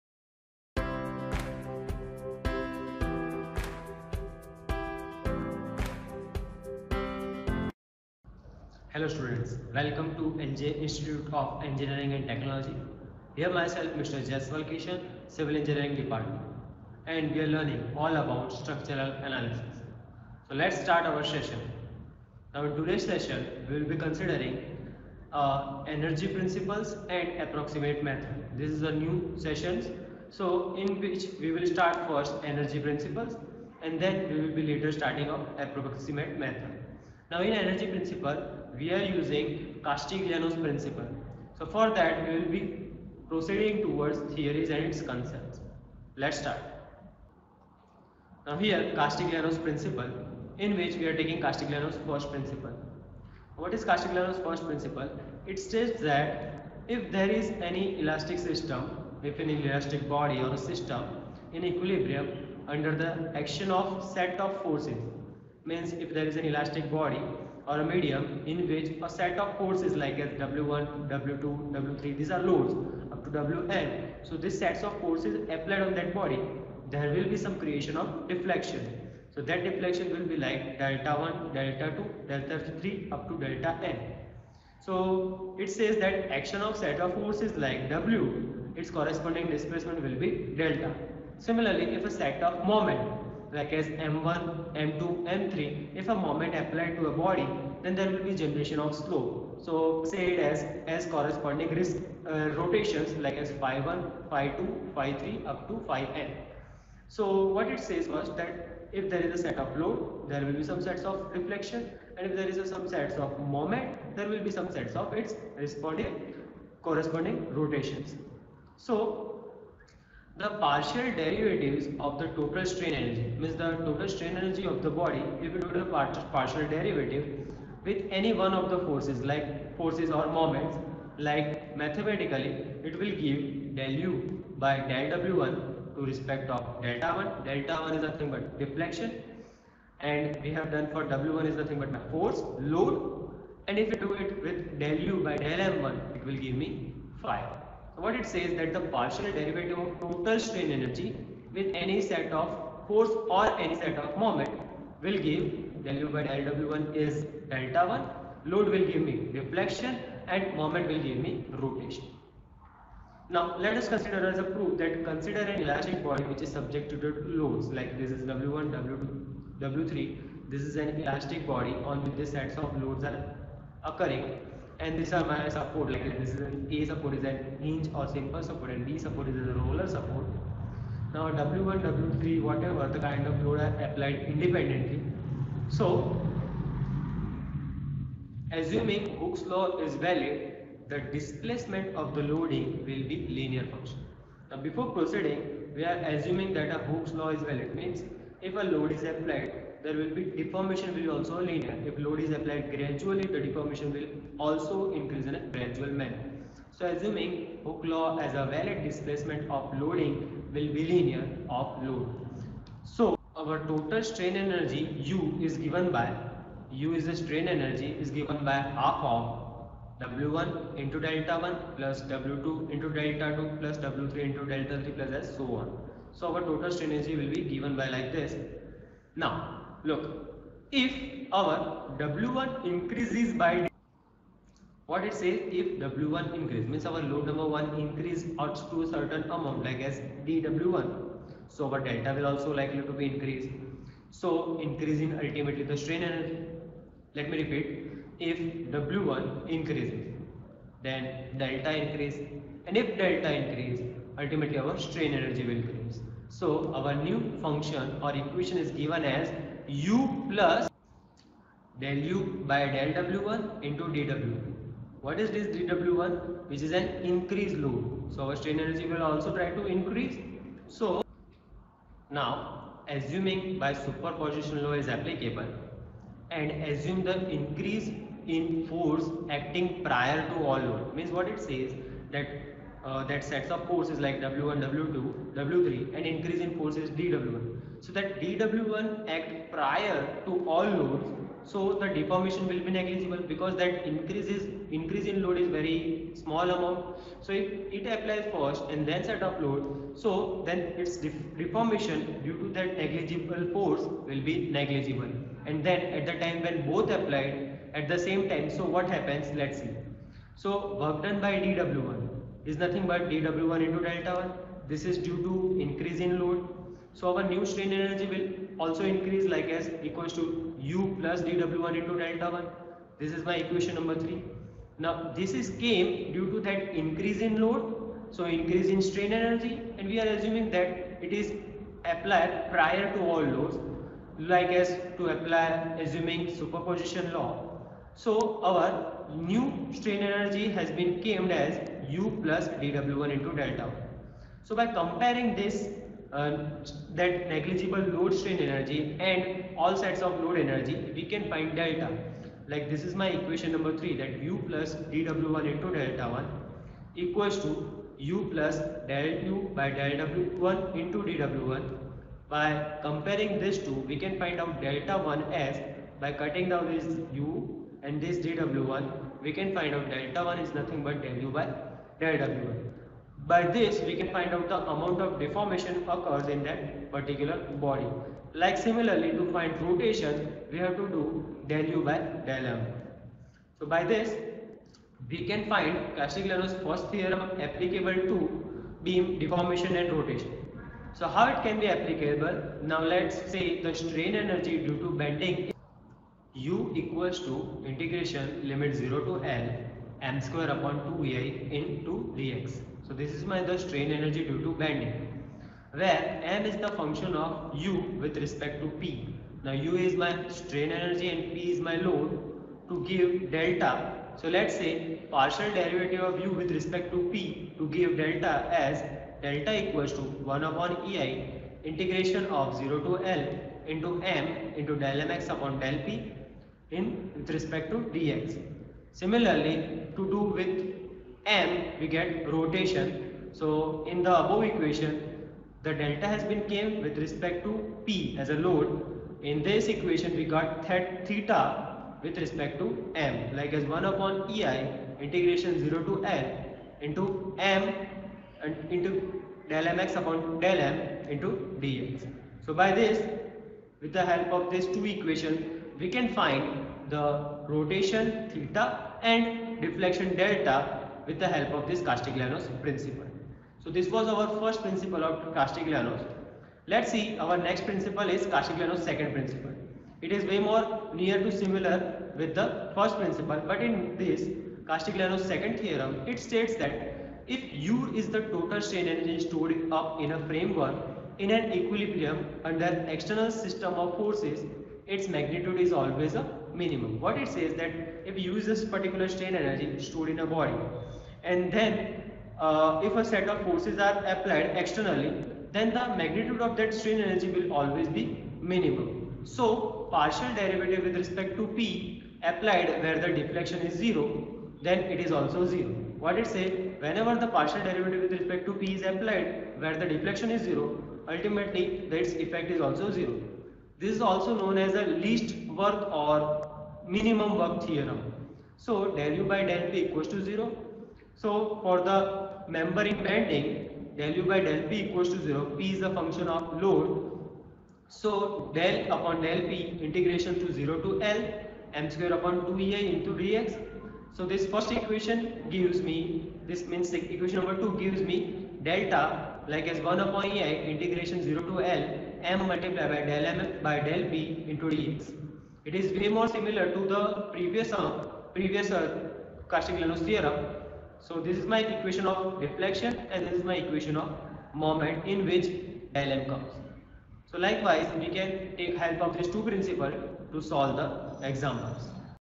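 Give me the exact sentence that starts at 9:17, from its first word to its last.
So likewise, we can take help of these two principles to solve the examples.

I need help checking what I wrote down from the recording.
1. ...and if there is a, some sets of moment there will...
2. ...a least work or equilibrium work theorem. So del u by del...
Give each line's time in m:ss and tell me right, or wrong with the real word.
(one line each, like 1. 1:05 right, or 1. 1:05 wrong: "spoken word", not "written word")
1. 1:52 right
2. 8:34 wrong: "minimum", not "equilibrium".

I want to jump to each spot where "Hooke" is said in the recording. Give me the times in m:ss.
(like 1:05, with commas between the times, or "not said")
3:09, 3:16, 3:27.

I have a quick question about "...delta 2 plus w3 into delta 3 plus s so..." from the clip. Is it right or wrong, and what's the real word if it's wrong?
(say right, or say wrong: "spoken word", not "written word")
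right.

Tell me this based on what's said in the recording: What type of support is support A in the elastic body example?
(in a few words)
Simple support.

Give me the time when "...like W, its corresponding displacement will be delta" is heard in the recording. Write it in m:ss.
1:27.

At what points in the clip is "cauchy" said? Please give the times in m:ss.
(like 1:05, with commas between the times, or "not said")
9:09.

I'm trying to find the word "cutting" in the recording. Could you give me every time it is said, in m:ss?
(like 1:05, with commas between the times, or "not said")
6:06.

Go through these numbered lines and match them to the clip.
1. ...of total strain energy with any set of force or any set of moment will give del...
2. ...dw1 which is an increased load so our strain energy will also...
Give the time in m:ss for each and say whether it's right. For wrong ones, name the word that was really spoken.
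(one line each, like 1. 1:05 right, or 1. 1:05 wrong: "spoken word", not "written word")
1. 2:29 right
2. 4:25 right.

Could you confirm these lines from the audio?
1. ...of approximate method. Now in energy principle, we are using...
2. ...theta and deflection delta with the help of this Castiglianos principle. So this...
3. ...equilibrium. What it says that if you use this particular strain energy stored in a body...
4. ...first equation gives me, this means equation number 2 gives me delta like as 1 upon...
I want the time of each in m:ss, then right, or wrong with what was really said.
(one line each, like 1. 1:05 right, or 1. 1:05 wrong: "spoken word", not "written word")
1. 0:35 right
2. 7:38 right
3. 8:06 wrong: "minimum", not "equilibrium"
4. 8:54 right.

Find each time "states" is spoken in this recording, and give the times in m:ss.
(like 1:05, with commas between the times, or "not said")
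0:55, 7:56.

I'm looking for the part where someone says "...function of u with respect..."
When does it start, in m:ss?
6:46.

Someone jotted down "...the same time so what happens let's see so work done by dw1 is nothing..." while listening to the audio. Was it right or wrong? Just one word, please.
right.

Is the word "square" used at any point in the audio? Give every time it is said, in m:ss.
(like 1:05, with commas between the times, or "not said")
6:40, 8:51.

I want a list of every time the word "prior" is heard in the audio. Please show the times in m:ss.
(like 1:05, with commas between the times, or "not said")
4:39, 4:49, 5:32.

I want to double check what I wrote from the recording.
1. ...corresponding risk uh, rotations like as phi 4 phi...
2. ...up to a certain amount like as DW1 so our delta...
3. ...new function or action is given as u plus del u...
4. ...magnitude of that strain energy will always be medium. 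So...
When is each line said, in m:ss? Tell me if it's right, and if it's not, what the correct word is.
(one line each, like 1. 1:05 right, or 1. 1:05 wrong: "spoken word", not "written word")
1. 1:41 wrong: "1", not "4"
2. 3:58 right
3. 4:16 wrong: "equation", not "action"
4. 8:15 wrong: "minimum", not "medium".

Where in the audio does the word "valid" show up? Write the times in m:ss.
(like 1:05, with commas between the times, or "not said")
3:09, 3:17, 3:28.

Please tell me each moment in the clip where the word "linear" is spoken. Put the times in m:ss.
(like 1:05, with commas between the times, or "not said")
3:13, 3:21, 3:30.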